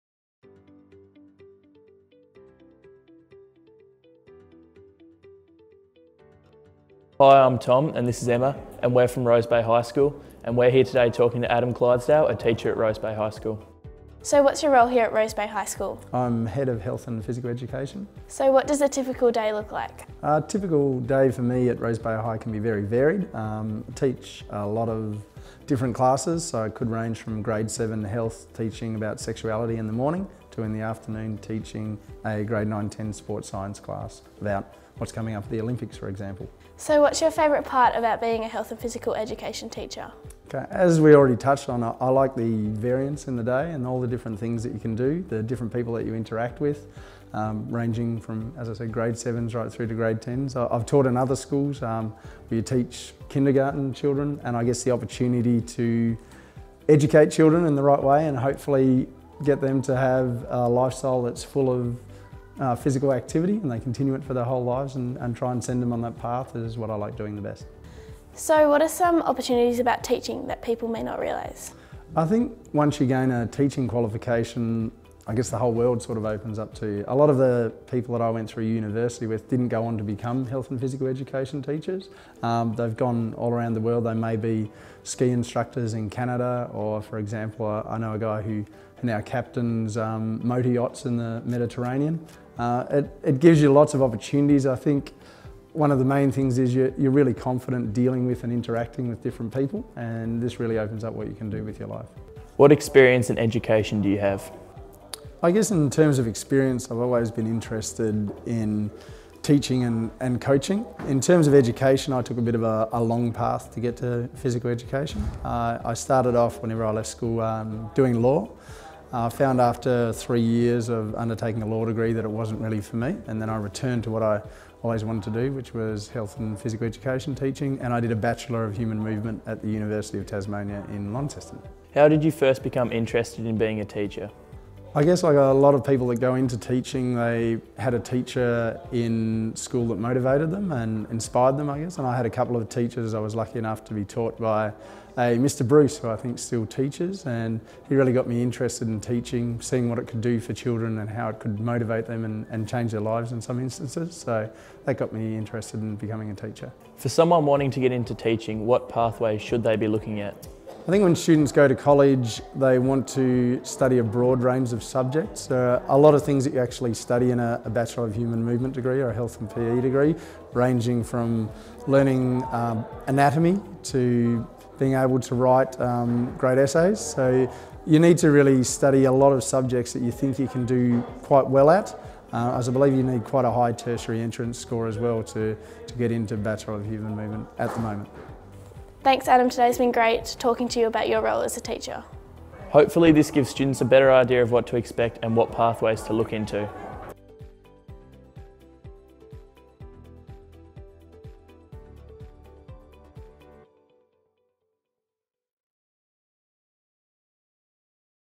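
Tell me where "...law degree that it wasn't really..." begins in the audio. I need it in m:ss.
2:01.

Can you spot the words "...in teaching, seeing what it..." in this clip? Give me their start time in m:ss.
2:28.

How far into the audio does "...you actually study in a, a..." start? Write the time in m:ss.
2:46.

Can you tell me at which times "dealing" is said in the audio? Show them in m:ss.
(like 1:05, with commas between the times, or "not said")
1:37.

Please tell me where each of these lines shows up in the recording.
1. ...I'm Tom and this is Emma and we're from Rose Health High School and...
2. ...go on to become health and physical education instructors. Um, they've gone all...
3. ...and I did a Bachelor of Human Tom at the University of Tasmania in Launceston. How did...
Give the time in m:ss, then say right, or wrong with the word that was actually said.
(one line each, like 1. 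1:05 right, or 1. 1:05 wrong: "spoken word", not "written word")
1. 0:07 wrong: "Bay", not "Health"
2. 1:19 wrong: "teachers", not "instructors"
3. 2:07 wrong: "Movement", not "Tom".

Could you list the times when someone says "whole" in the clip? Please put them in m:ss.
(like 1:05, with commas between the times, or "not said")
1:04, 1:15.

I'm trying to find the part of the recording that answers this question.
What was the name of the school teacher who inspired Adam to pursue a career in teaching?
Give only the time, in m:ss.
2:25.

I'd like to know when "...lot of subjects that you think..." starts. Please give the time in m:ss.
2:59.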